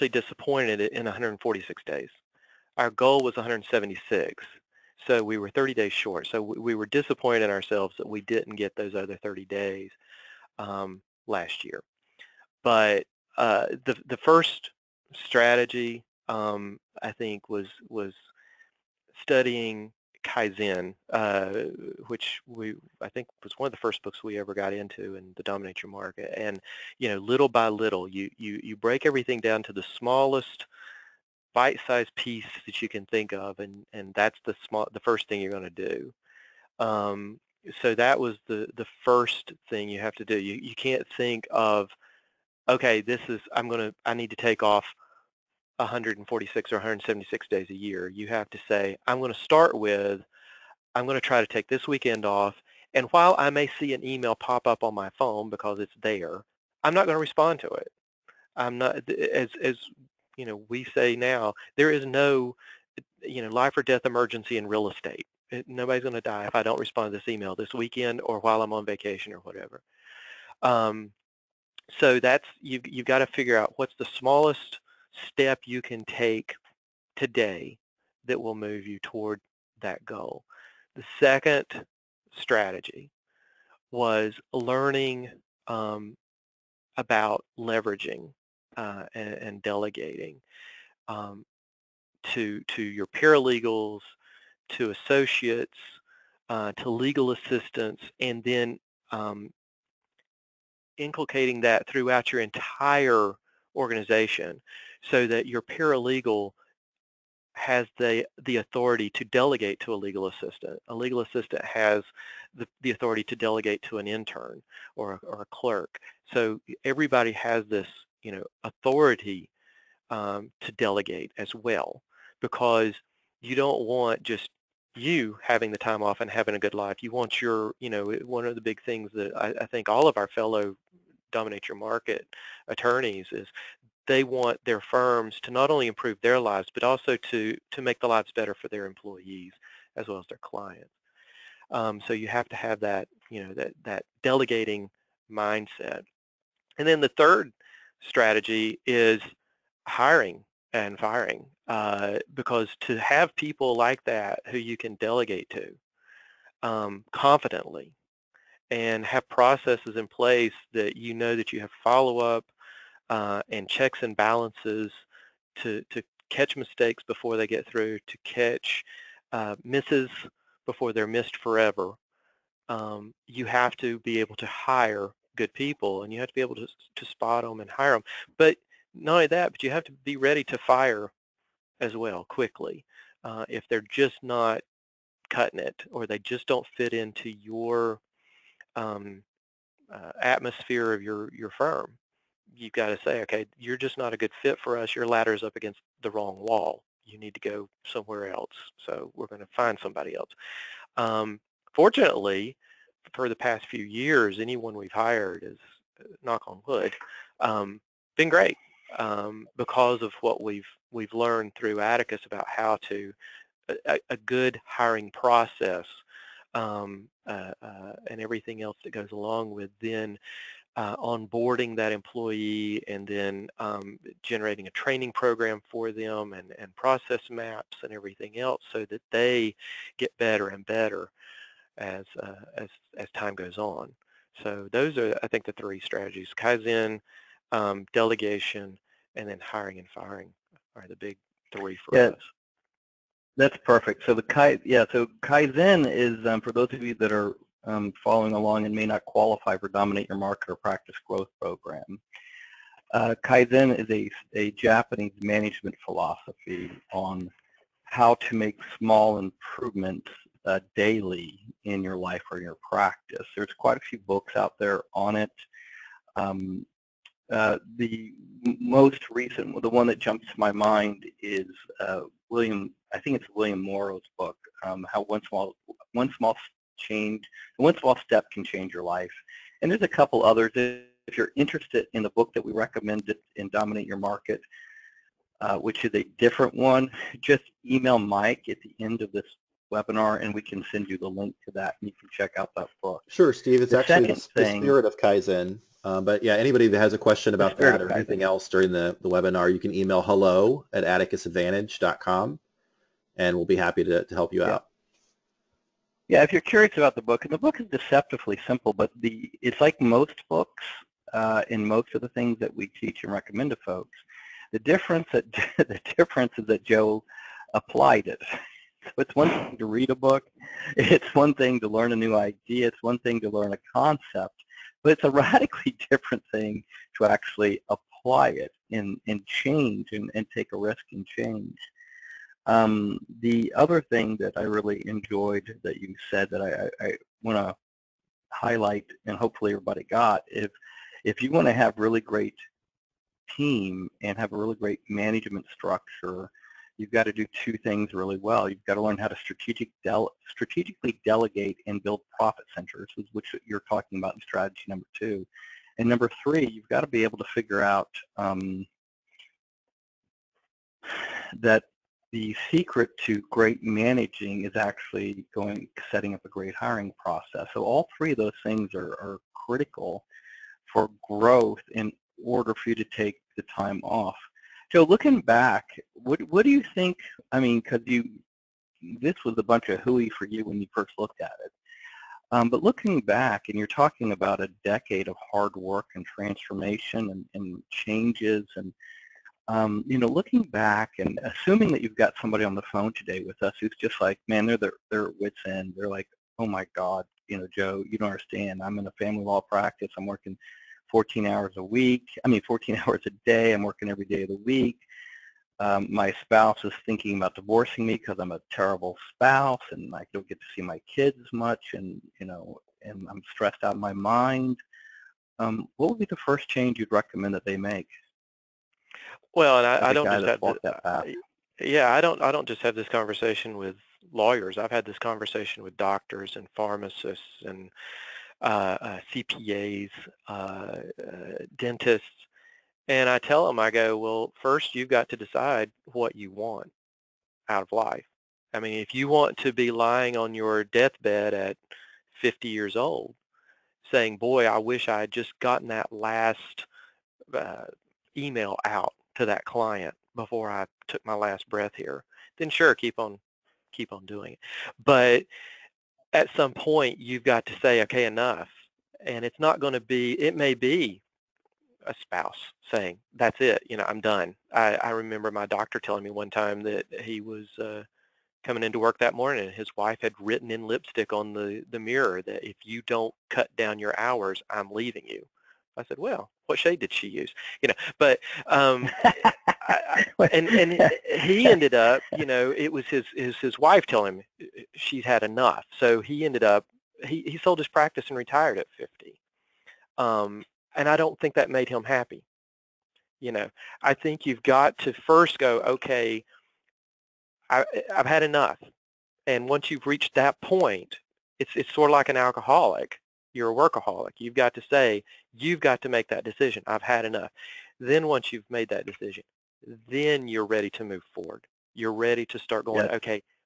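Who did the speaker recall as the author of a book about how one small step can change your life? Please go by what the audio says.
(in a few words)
William Morrow.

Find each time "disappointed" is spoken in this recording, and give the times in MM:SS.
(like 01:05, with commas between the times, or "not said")
00:00, 00:06.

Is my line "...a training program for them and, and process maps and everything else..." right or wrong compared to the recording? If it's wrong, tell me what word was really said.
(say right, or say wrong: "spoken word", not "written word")
right.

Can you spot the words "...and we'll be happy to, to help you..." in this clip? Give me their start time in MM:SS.
05:03.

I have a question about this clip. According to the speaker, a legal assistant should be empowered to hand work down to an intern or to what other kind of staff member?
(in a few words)
A clerk.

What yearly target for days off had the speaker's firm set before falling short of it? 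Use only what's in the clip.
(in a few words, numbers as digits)
176.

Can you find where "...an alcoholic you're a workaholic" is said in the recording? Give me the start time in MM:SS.
08:22.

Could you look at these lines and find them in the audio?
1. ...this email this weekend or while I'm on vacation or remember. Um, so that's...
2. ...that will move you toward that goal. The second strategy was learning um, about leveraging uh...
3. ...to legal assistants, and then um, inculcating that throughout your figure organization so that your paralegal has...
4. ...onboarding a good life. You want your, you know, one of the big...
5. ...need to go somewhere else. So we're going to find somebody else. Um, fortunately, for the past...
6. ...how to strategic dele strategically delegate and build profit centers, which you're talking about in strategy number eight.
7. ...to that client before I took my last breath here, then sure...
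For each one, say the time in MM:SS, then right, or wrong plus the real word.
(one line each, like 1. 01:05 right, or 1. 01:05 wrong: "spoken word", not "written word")
1. 01:07 wrong: "whatever", not "remember"
2. 01:18 right
3. 01:36 wrong: "entire", not "figure"
4. 02:06 wrong: "having", not "onboarding"
5. 03:17 right
6. 05:48 wrong: "two", not "eight"
7. 07:29 right.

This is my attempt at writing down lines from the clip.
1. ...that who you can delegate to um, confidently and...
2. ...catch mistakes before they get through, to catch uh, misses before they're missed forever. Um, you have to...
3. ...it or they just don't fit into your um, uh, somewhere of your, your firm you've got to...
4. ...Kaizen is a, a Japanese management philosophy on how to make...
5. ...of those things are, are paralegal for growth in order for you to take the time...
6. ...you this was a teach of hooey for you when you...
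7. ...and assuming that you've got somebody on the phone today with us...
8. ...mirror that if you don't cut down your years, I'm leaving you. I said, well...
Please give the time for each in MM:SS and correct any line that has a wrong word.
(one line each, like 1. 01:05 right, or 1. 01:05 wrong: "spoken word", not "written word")
1. 02:34 right
2. 02:46 right
3. 03:05 wrong: "atmosphere", not "somewhere"
4. 04:13 right
5. 06:08 wrong: "critical", not "paralegal"
6. 06:17 wrong: "bunch", not "teach"
7. 06:30 right
8. 07:51 wrong: "hours", not "years".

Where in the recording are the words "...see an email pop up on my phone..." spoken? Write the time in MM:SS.
00:53.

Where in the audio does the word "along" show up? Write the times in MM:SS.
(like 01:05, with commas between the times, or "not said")
03:39, 04:08.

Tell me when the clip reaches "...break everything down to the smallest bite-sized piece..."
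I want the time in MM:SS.
00:28.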